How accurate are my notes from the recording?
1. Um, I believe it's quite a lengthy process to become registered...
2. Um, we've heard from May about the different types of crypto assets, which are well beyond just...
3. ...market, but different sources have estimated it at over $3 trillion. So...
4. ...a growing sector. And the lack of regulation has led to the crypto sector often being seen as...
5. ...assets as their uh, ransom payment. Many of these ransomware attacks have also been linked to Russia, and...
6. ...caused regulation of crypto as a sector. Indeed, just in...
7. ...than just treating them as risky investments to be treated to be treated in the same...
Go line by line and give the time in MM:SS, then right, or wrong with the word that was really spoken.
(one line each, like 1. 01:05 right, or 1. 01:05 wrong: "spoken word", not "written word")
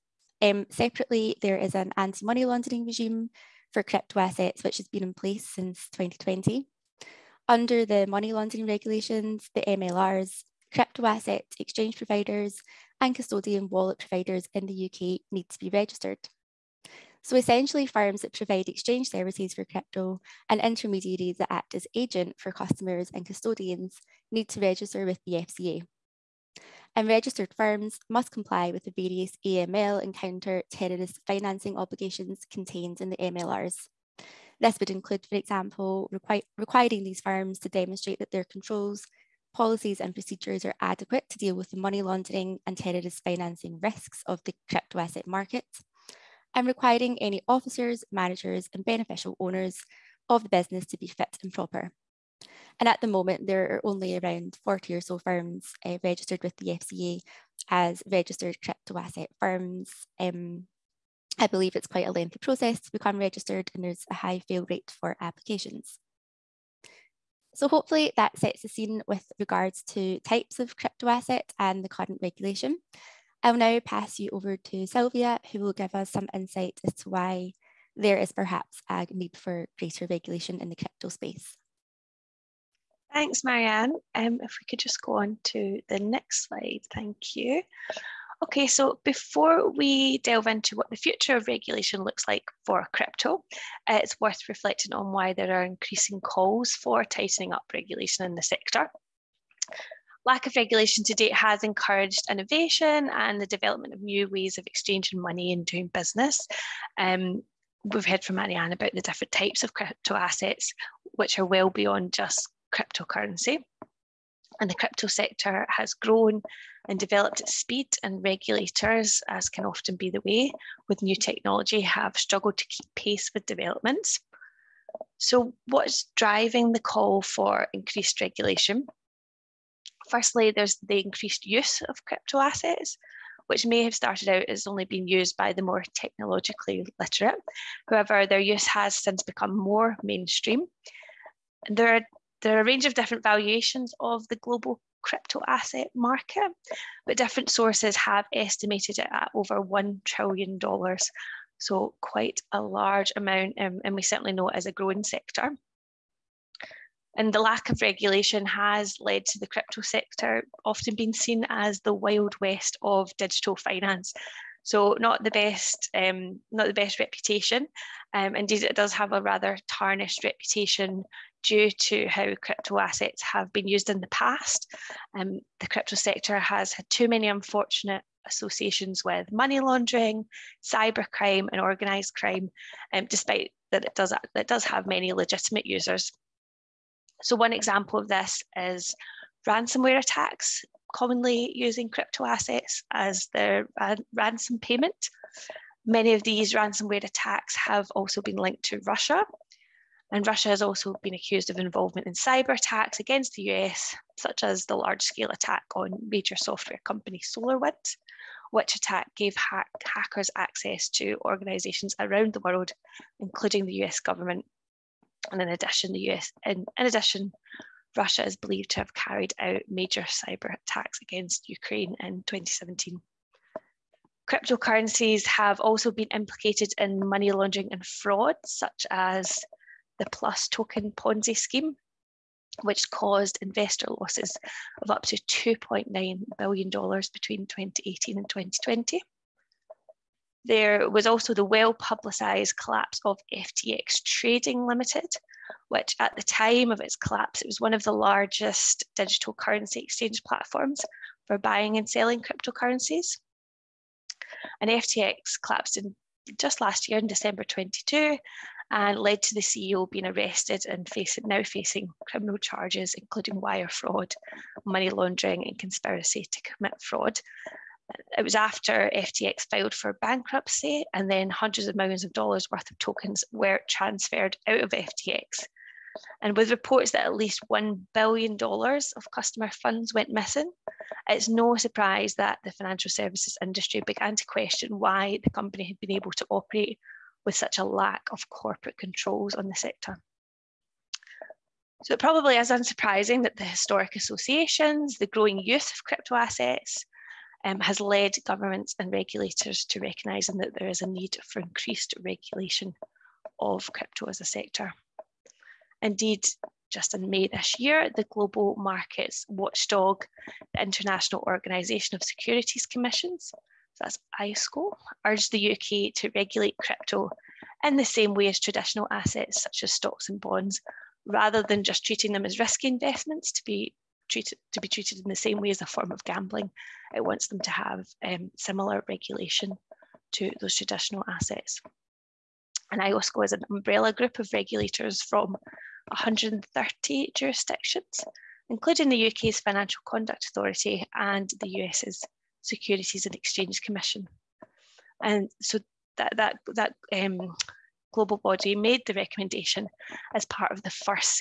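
1. 01:00 right
2. 01:46 wrong: "Marianne", not "May"
3. 02:25 wrong: "1", not "3"
4. 02:34 right
5. 03:12 right
6. 05:01 wrong: "increased", not "caused"
7. 05:21 right.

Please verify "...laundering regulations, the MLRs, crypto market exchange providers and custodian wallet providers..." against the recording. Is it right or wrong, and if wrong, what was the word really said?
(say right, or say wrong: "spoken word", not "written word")
wrong: "asset", not "market".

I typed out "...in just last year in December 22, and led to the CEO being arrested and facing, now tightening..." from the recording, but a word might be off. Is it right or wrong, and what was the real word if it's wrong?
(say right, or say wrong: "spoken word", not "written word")
wrong: "facing", not "tightening".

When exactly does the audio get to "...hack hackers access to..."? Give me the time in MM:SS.
03:29.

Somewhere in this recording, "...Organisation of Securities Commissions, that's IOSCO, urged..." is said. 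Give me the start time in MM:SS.
05:11.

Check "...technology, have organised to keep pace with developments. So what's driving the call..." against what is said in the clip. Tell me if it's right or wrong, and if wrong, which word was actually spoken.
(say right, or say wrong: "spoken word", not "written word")
wrong: "struggled", not "organised".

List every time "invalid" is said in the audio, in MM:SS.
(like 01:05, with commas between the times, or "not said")
not said.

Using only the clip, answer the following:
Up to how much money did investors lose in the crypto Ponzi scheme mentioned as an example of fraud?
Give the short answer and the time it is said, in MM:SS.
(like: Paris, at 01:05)
$2.9 billion, at 03:55.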